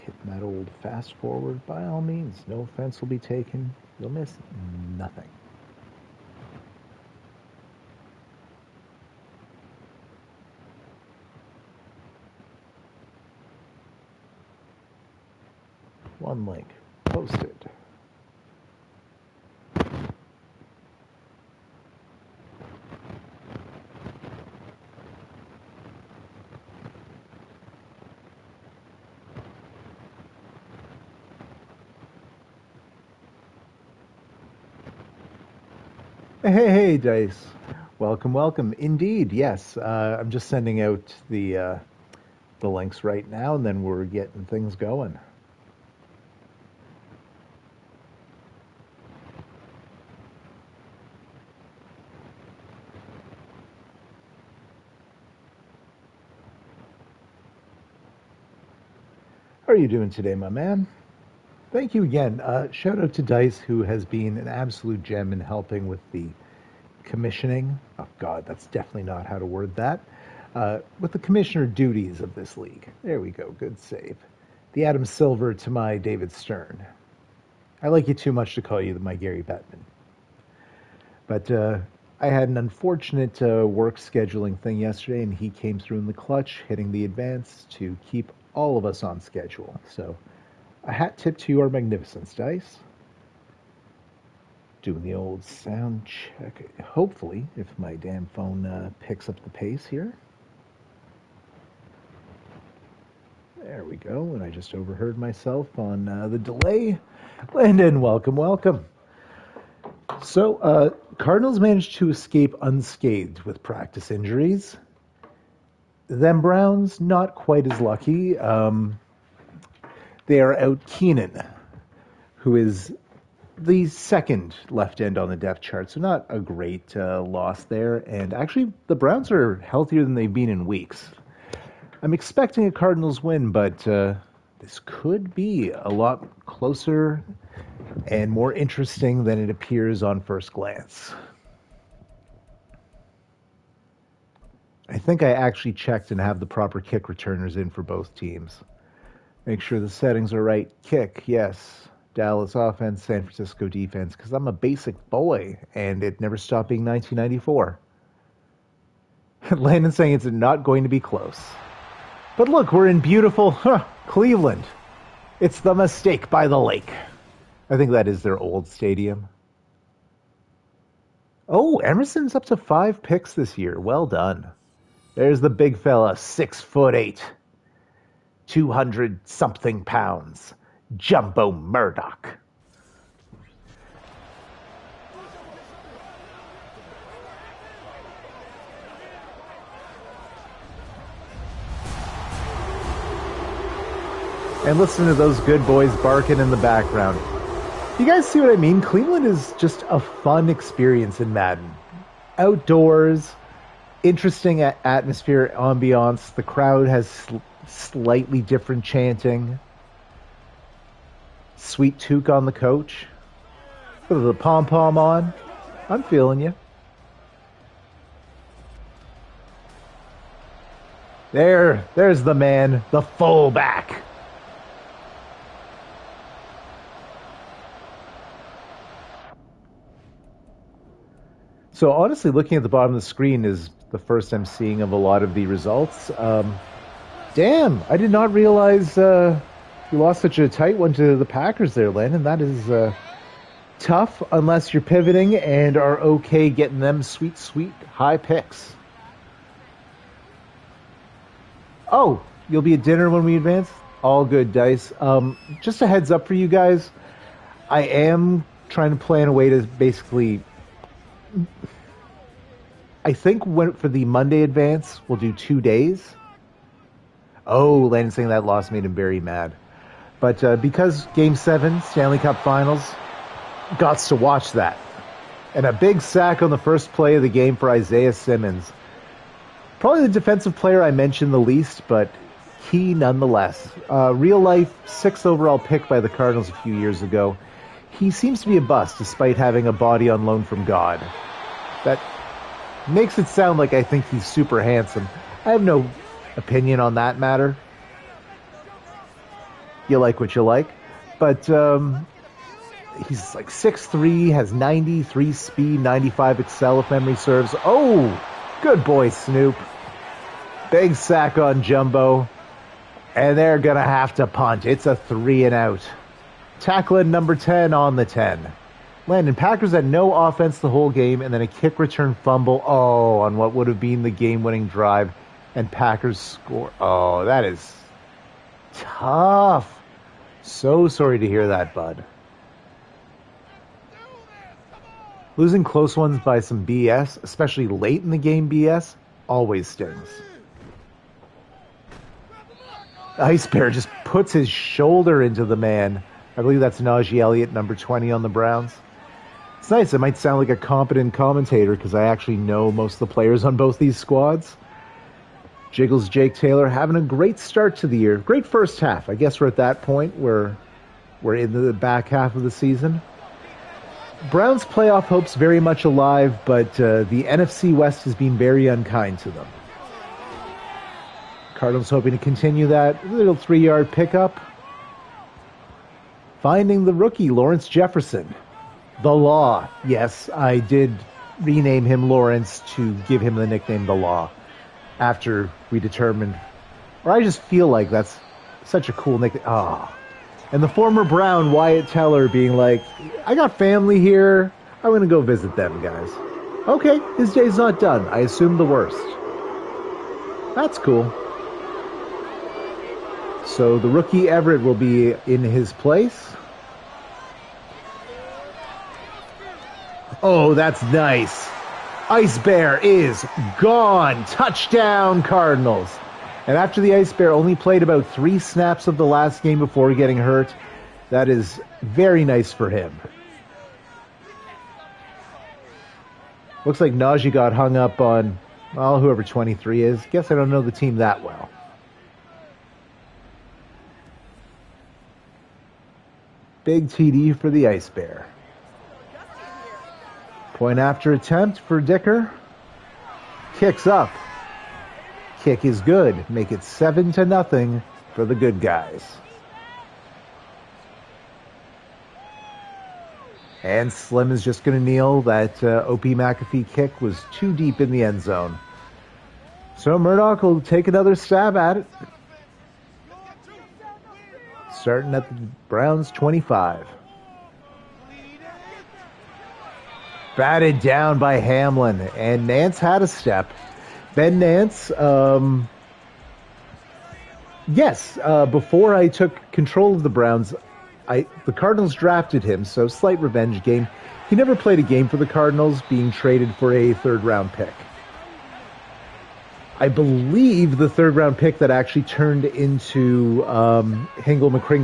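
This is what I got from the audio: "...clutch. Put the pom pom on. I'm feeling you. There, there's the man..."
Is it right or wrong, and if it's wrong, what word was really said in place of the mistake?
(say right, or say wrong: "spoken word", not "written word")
wrong: "coach", not "clutch".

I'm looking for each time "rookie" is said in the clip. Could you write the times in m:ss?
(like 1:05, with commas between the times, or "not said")
6:16, 6:43.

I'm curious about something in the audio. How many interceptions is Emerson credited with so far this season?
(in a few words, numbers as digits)
5.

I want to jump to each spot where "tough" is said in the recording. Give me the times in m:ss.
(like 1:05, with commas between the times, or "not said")
4:03, 5:28.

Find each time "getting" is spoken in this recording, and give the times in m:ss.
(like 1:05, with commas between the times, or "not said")
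0:44, 4:06, 6:59.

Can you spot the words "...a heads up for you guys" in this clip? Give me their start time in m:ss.
4:15.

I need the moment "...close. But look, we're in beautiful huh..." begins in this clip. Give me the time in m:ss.
2:40.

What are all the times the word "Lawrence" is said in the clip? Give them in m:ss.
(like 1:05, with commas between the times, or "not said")
6:17, 6:22.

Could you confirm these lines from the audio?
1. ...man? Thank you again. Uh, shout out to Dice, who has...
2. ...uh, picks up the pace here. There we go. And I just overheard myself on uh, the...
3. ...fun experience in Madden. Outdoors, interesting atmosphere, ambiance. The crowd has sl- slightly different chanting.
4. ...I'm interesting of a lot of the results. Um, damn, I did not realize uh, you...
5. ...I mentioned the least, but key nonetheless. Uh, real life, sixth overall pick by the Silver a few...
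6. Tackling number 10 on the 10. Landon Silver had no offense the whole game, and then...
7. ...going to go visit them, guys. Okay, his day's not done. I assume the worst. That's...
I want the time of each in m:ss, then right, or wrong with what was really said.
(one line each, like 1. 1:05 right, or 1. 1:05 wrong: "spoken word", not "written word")
1. 1:00 right
2. 1:38 right
3. 3:19 right
4. 3:54 wrong: "seeing", not "interesting"
5. 4:40 wrong: "Cardinals", not "Silver"
6. 5:16 wrong: "Packers", not "Silver"
7. 6:34 right.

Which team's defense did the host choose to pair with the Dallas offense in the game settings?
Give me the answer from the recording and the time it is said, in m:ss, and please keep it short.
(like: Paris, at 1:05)
San Francisco, at 2:33.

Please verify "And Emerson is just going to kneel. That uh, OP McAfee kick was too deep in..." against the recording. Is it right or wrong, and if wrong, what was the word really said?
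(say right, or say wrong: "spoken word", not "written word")
wrong: "Slim", not "Emerson".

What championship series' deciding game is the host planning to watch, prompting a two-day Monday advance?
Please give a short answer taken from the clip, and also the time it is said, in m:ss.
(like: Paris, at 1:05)
Stanley Cup Finals, at 4:31.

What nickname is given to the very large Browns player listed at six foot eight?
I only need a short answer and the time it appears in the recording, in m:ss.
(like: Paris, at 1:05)
Jumbo Murdoch, at 3:00.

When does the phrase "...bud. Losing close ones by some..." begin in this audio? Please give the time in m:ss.
5:31.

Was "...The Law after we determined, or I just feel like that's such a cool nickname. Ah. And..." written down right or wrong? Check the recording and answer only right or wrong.
right.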